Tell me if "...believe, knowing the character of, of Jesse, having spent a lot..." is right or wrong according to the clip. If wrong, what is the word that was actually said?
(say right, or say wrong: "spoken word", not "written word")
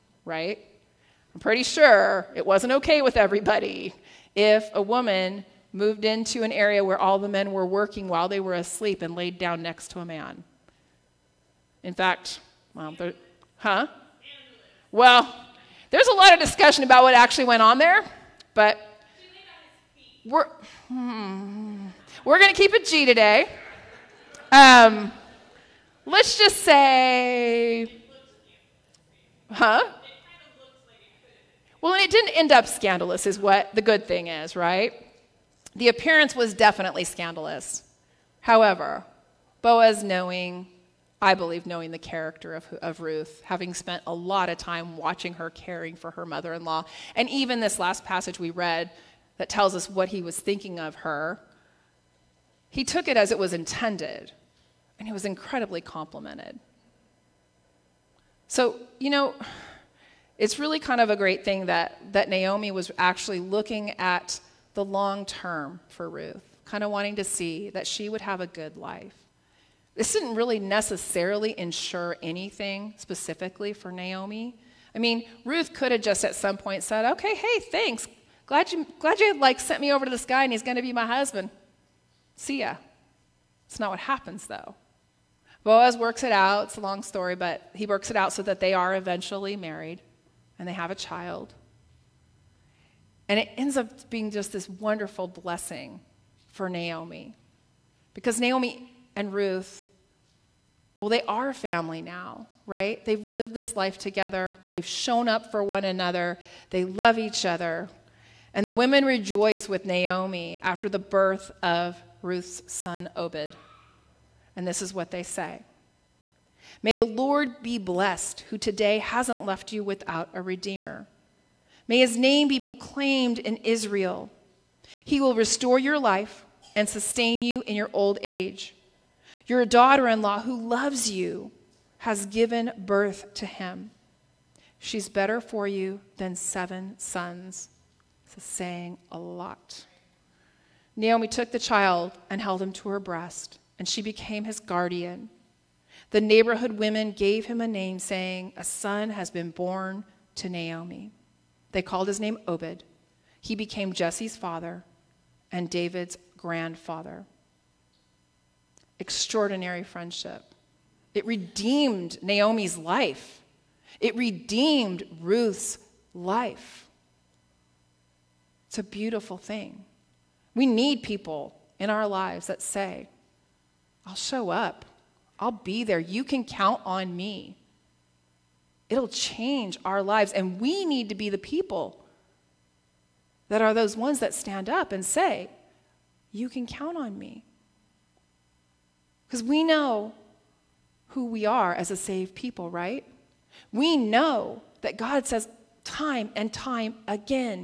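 wrong: "Ruth", not "Jesse".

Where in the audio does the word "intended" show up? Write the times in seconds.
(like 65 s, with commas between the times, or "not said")
53 s.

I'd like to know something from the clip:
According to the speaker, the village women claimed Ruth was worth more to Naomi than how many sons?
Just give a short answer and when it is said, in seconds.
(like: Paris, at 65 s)
7, at 136 s.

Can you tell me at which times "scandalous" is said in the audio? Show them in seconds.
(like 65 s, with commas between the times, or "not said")
32 s, 37 s.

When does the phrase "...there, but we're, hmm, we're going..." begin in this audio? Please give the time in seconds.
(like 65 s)
17 s.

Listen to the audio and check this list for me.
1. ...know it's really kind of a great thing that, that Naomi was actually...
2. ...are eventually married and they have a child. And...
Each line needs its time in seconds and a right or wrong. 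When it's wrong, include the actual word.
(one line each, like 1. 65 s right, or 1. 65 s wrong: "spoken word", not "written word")
1. 59 s right
2. 88 s right.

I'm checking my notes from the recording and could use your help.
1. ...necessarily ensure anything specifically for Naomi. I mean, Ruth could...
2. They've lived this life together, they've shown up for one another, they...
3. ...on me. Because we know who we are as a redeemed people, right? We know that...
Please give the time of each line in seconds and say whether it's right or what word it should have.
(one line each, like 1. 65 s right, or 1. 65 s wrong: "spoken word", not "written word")
1. 70 s right
2. 103 s right
3. 186 s wrong: "saved", not "redeemed".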